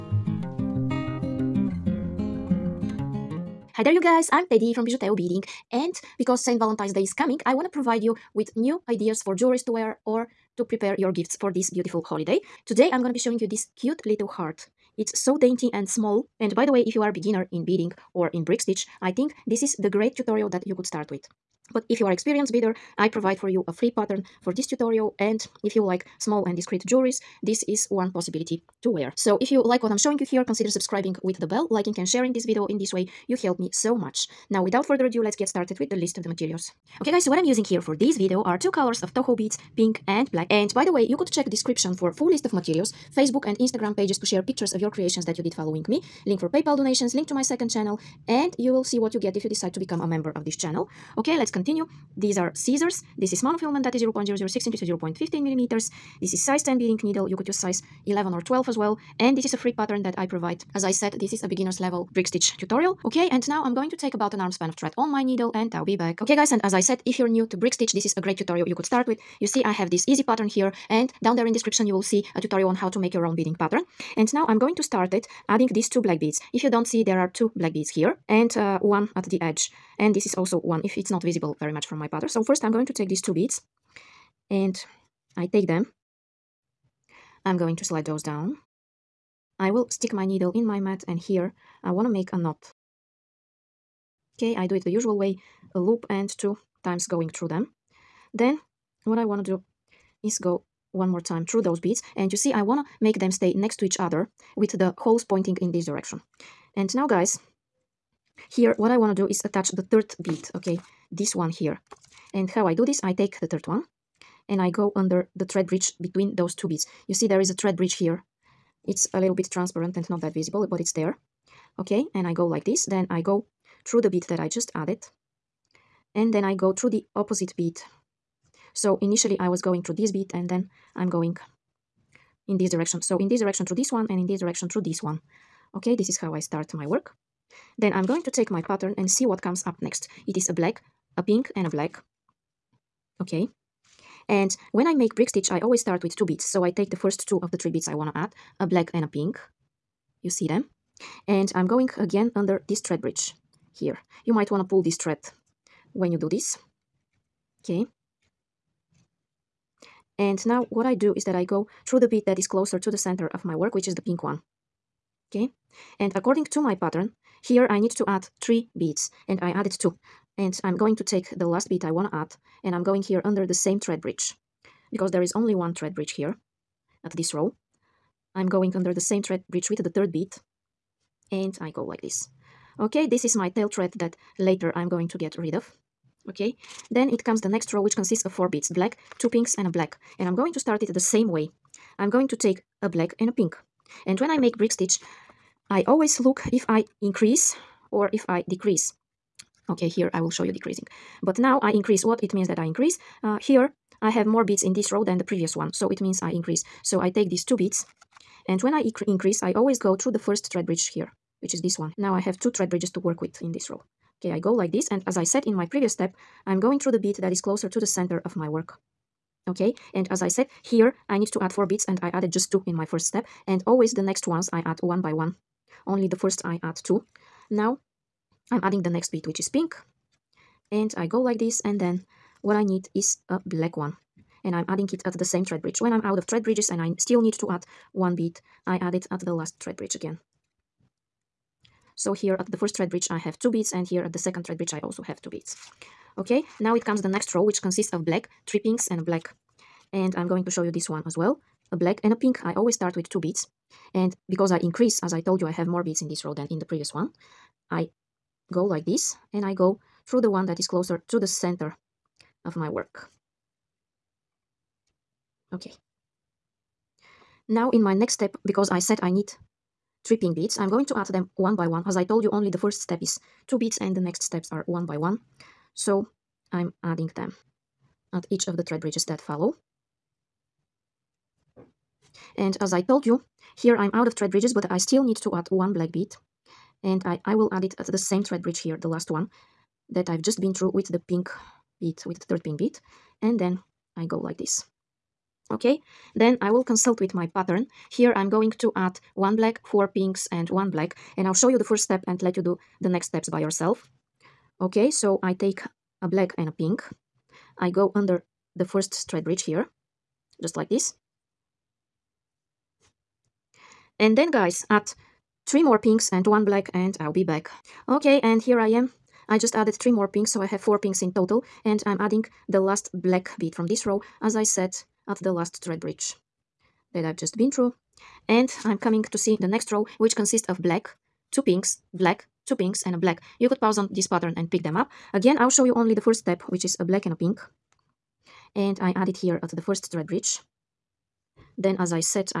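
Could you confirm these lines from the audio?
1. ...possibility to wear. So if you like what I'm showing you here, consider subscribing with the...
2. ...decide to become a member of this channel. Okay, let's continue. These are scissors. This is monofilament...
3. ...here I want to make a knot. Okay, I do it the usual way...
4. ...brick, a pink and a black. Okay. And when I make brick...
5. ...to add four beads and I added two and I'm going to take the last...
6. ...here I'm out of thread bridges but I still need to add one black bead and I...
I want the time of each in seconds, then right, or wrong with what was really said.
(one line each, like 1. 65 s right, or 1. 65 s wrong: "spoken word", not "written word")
1. 28 s right
2. 49 s right
3. 91 s right
4. 140 s wrong: "black", not "brick"
5. 167 s wrong: "three", not "four"
6. 283 s right.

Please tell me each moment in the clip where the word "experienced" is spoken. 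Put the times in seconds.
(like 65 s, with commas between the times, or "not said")
22 s.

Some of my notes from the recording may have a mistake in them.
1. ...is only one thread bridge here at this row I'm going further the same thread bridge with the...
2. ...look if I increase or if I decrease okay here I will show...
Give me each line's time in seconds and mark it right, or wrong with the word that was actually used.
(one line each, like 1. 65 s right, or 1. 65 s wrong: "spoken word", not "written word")
1. 175 s wrong: "under", not "further"
2. 196 s right.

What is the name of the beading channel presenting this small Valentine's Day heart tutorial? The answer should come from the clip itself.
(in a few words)
Bijuteo Beading.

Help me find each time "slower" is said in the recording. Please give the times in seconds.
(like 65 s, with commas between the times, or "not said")
not said.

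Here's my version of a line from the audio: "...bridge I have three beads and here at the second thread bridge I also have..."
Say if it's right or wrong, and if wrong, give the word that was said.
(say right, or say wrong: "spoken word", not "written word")
wrong: "two", not "three".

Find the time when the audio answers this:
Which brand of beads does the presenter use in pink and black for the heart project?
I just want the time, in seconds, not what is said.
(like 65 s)
39 s.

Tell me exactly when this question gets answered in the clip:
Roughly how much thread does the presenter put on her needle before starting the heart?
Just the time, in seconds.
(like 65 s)
64 s.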